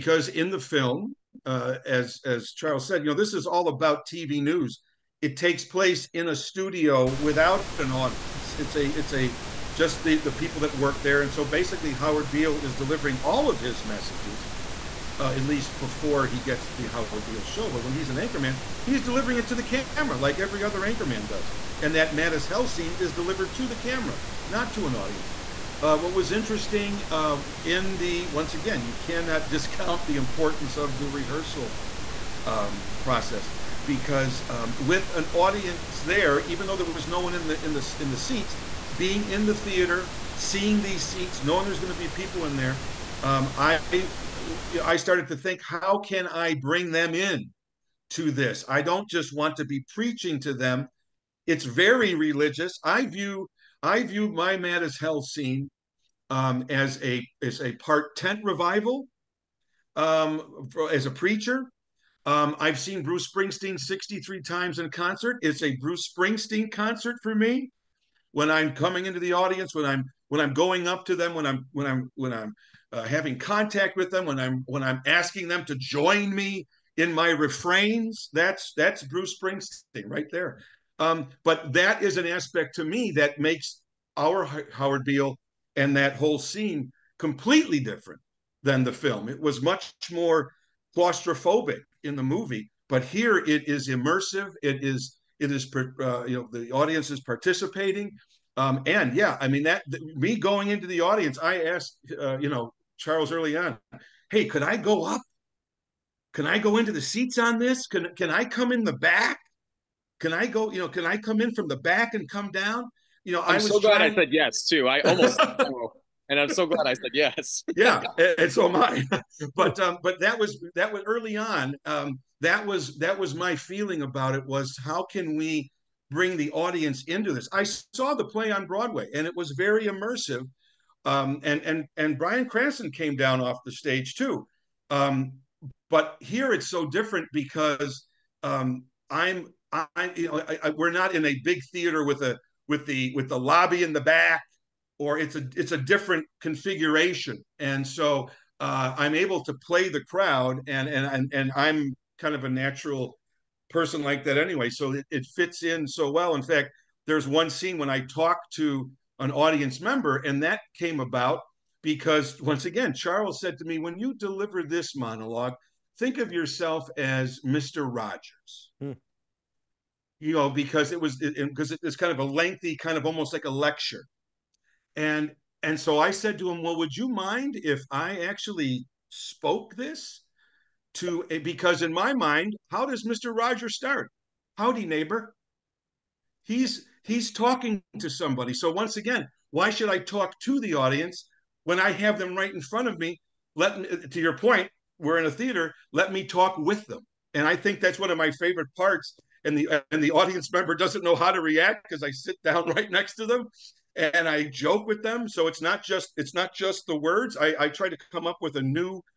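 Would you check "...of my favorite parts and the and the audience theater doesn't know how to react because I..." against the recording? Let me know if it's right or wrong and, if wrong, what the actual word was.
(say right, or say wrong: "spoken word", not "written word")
wrong: "member", not "theater".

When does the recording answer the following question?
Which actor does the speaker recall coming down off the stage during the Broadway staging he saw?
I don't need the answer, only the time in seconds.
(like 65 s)
132 s.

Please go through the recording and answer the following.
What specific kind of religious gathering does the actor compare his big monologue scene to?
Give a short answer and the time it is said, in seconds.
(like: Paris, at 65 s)
tent revival, at 58 s.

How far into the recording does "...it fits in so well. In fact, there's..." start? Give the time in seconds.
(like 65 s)
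155 s.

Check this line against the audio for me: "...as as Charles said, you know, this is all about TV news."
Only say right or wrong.
right.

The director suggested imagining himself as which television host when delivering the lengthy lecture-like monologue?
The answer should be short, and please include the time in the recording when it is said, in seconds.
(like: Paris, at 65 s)
Mr. Rogers, at 167 s.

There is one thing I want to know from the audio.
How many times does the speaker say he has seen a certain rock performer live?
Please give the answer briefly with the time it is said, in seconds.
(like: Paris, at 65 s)
63, at 63 s.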